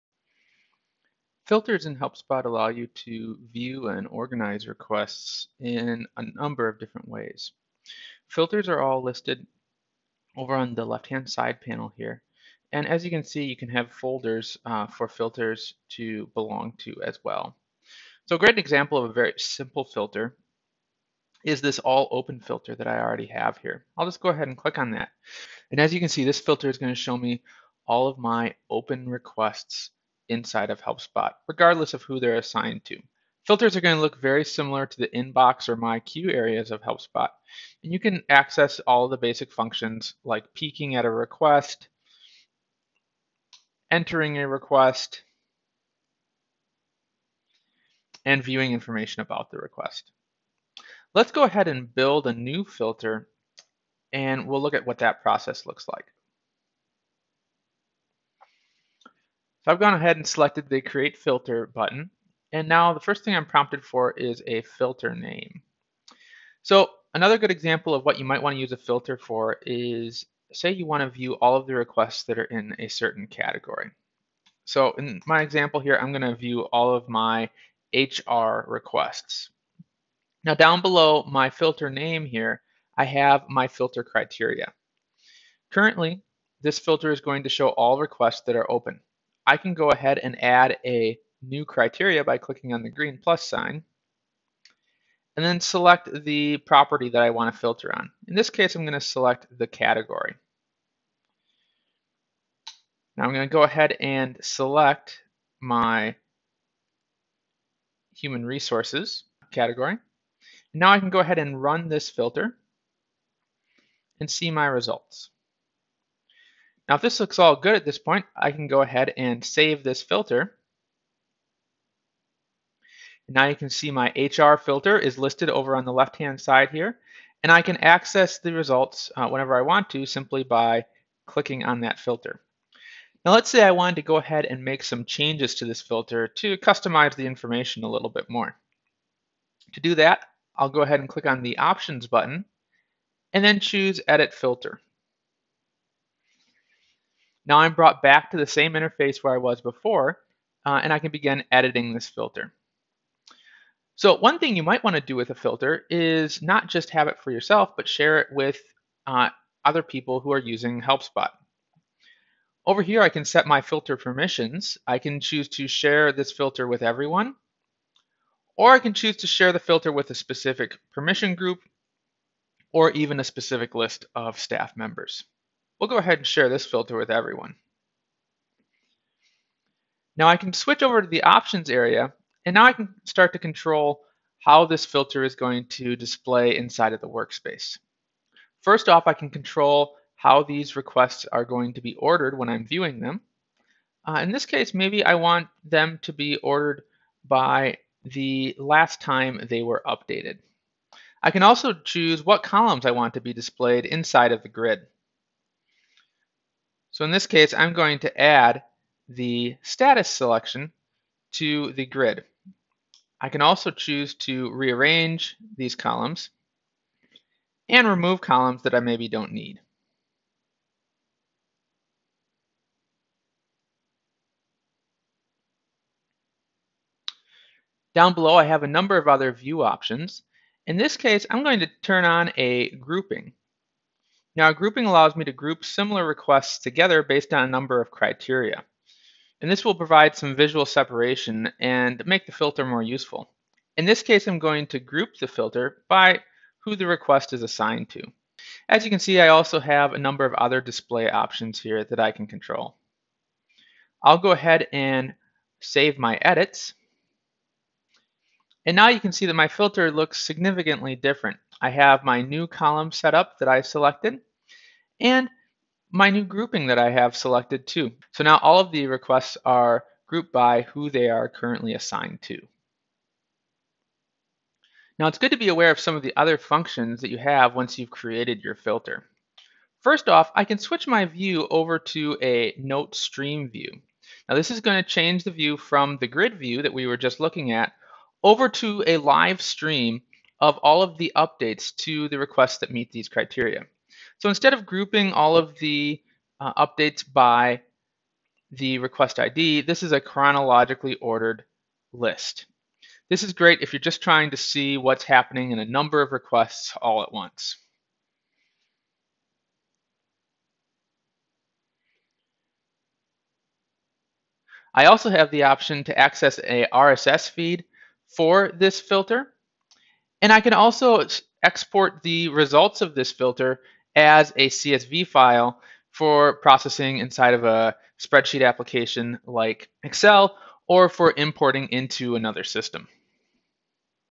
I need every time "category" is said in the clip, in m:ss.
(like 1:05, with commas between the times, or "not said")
1:13, 1:39, 1:49.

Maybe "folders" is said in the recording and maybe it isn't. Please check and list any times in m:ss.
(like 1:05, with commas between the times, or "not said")
0:13.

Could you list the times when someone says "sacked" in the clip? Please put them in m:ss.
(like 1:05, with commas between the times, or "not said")
not said.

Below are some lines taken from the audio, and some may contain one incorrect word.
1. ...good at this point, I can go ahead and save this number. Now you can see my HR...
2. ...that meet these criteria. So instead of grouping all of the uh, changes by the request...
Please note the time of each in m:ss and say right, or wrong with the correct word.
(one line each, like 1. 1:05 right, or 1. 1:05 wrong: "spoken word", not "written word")
1. 1:57 wrong: "filter", not "number"
2. 4:52 wrong: "updates", not "changes".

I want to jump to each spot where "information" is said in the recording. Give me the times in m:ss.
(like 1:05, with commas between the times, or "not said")
0:48, 2:17.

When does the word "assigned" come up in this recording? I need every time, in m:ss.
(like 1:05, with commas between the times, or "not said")
0:32, 4:07, 4:31.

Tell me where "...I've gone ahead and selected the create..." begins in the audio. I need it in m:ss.
0:59.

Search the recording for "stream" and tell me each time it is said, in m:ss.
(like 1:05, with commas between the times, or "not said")
4:42, 4:49.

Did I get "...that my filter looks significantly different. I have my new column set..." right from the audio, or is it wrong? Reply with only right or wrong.
right.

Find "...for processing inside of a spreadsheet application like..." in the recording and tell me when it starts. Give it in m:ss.
5:25.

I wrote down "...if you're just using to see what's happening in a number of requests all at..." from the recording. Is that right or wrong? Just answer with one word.
wrong.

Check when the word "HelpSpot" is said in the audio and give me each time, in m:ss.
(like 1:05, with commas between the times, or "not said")
0:01, 0:30, 0:36, 2:40.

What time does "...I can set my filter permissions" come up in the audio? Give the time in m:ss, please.
2:43.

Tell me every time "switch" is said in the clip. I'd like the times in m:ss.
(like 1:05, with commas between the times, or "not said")
3:00, 4:40.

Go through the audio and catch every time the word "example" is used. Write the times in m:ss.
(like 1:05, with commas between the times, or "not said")
0:18, 1:07, 1:15.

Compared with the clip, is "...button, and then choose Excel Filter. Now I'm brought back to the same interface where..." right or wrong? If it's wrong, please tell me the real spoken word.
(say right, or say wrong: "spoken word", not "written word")
wrong: "Edit", not "Excel".